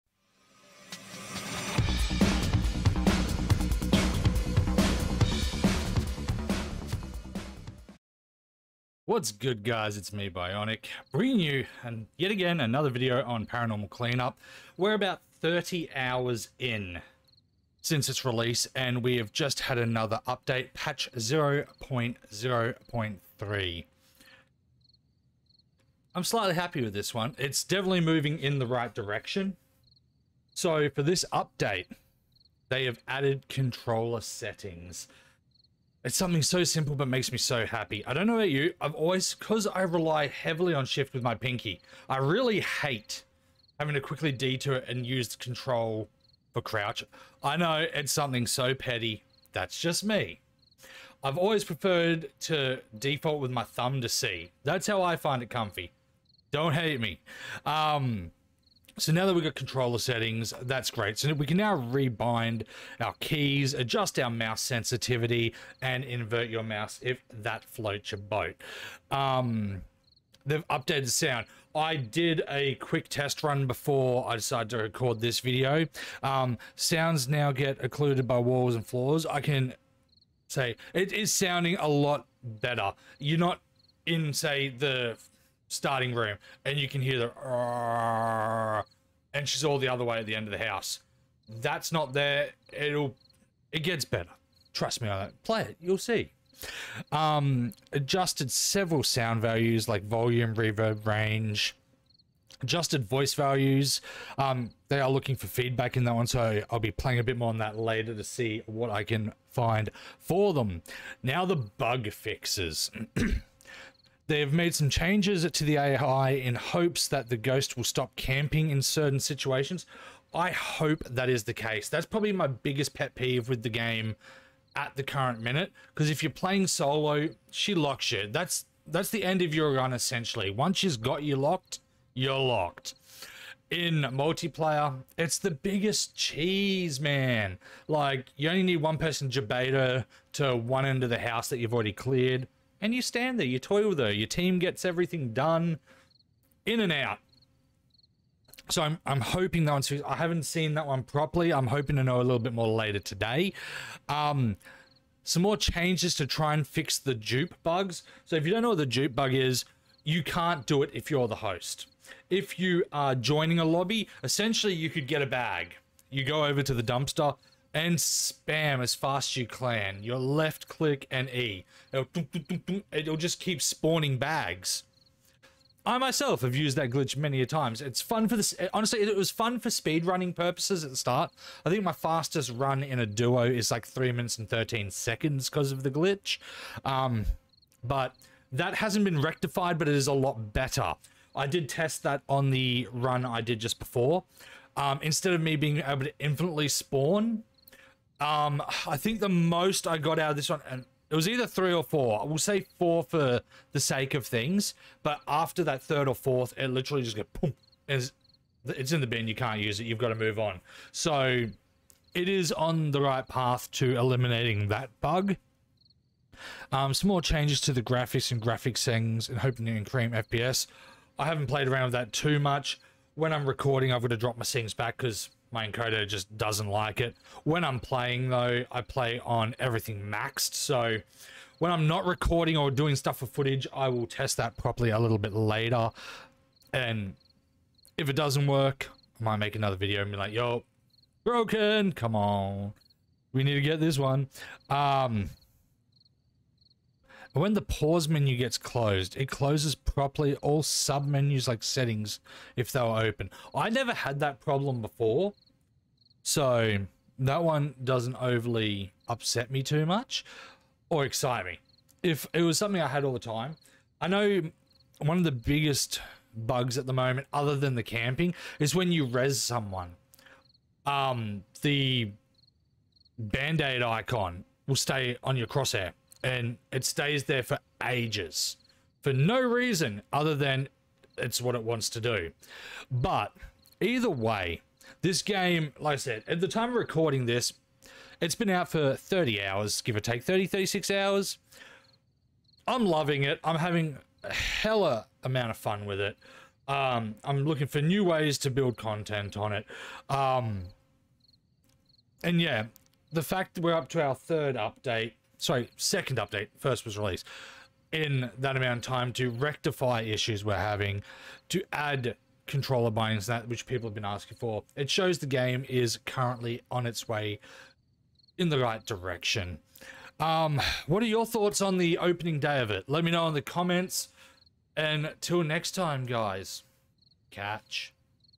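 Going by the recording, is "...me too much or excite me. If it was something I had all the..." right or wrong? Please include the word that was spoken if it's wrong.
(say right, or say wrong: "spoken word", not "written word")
right.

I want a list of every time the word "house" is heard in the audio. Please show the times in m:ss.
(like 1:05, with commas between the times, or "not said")
1:30, 2:21.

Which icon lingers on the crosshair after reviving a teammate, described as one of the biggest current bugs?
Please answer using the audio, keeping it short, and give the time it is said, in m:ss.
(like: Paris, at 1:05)
band-aid icon, at 4:33.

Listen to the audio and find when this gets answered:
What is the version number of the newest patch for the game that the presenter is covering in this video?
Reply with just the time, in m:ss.
0:20.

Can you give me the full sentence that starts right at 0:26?
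I'm slightly happy with this one.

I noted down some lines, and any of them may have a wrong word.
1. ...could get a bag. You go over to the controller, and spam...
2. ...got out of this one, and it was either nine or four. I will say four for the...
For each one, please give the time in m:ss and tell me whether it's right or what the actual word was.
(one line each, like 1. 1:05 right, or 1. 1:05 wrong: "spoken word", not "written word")
1. 2:44 wrong: "dumpster", not "controller"
2. 3:19 wrong: "three", not "nine".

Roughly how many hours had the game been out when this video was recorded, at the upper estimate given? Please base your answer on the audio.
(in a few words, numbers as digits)
36 hours.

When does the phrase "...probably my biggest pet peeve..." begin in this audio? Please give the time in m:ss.
2:02.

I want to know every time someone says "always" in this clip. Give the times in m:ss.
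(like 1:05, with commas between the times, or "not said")
0:38, 0:51.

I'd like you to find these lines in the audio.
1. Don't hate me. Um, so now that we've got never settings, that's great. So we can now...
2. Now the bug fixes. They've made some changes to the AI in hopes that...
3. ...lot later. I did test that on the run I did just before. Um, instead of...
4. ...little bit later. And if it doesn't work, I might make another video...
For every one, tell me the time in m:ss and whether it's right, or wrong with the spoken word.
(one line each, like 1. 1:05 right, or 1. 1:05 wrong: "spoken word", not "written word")
1. 0:56 wrong: "controller", not "never"
2. 1:51 right
3. 3:10 wrong: "better", not "later"
4. 3:54 right.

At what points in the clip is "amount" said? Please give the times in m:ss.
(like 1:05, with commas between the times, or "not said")
4:55, 5:08.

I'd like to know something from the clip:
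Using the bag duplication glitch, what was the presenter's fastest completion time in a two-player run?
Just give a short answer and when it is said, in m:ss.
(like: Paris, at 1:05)
3 minutes 13 seconds, at 3:03.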